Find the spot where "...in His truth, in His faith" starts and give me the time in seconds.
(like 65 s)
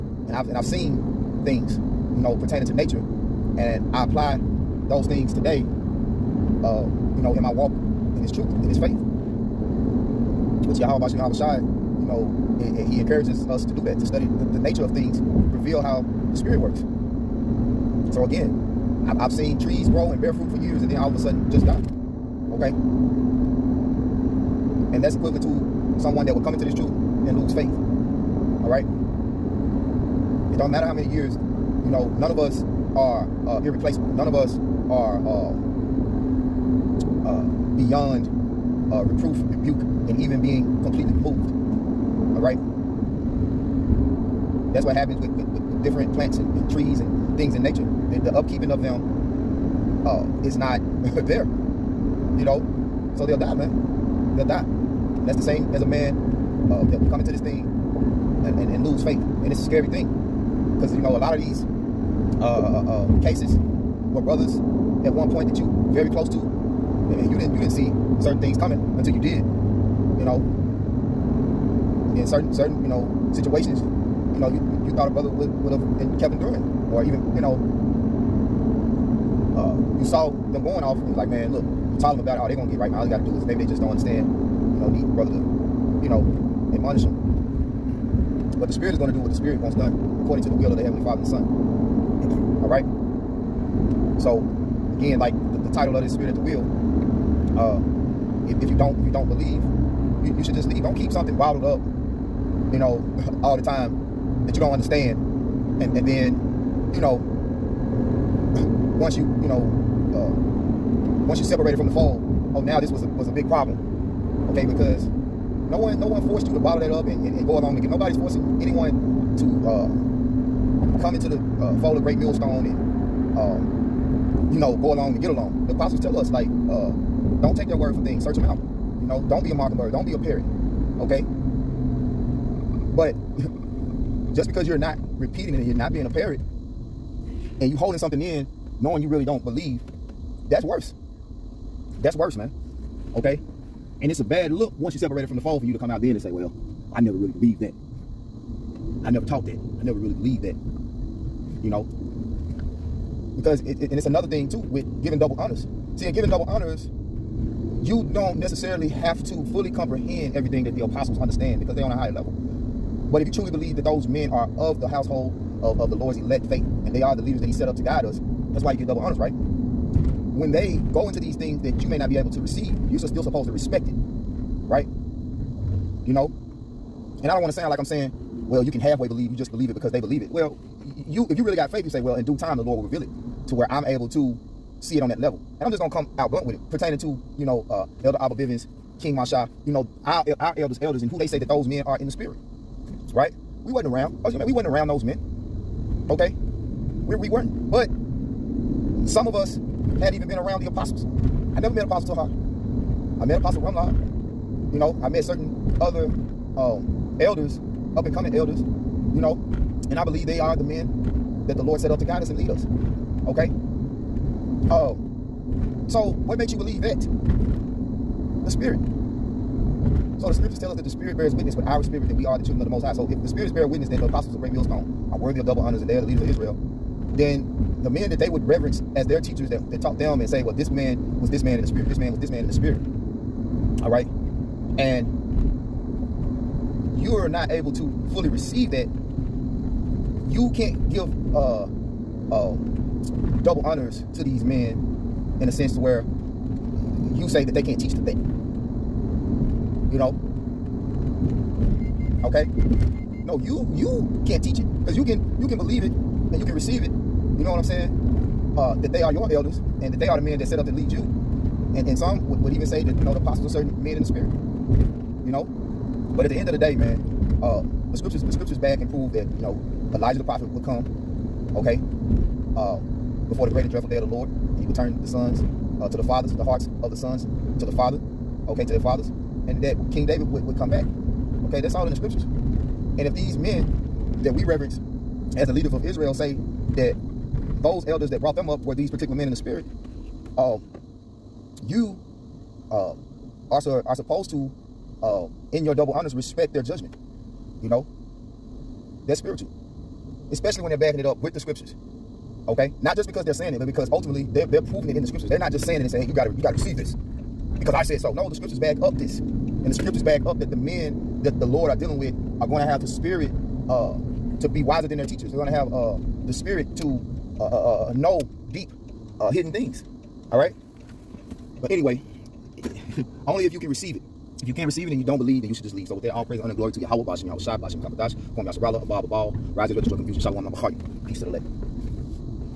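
7 s.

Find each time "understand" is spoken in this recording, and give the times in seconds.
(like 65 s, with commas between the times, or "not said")
83 s, 104 s, 161 s.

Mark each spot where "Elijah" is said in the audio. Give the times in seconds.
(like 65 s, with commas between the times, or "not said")
269 s.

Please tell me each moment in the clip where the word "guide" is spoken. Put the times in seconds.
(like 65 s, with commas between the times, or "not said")
167 s, 212 s.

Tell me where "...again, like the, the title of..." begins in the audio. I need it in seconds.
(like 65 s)
94 s.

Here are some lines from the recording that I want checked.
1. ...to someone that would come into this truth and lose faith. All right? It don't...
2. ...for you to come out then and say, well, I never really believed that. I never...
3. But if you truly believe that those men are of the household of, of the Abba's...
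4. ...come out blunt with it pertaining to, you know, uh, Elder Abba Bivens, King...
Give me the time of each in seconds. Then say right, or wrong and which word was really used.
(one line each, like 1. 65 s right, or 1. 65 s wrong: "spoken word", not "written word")
1. 25 s right
2. 145 s right
3. 163 s wrong: "Lord", not "Abba"
4. 185 s right.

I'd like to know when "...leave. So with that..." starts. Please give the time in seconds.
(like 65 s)
325 s.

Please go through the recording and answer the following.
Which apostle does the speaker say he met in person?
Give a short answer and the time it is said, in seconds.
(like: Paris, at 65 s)
Apostle Rumlod, at 203 s.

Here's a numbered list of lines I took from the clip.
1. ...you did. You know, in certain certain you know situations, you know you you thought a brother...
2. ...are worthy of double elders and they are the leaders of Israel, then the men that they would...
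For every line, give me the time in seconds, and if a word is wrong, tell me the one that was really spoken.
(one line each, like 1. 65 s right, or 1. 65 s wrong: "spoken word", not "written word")
1. 69 s right
2. 225 s wrong: "honors", not "elders".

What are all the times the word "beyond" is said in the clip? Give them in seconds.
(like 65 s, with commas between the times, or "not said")
37 s.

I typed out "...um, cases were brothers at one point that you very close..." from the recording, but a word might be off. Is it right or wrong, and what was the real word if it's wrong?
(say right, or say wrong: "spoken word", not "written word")
right.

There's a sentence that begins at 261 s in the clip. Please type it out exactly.
And and some would, would even say that you know the apostles are certain men in the spirit.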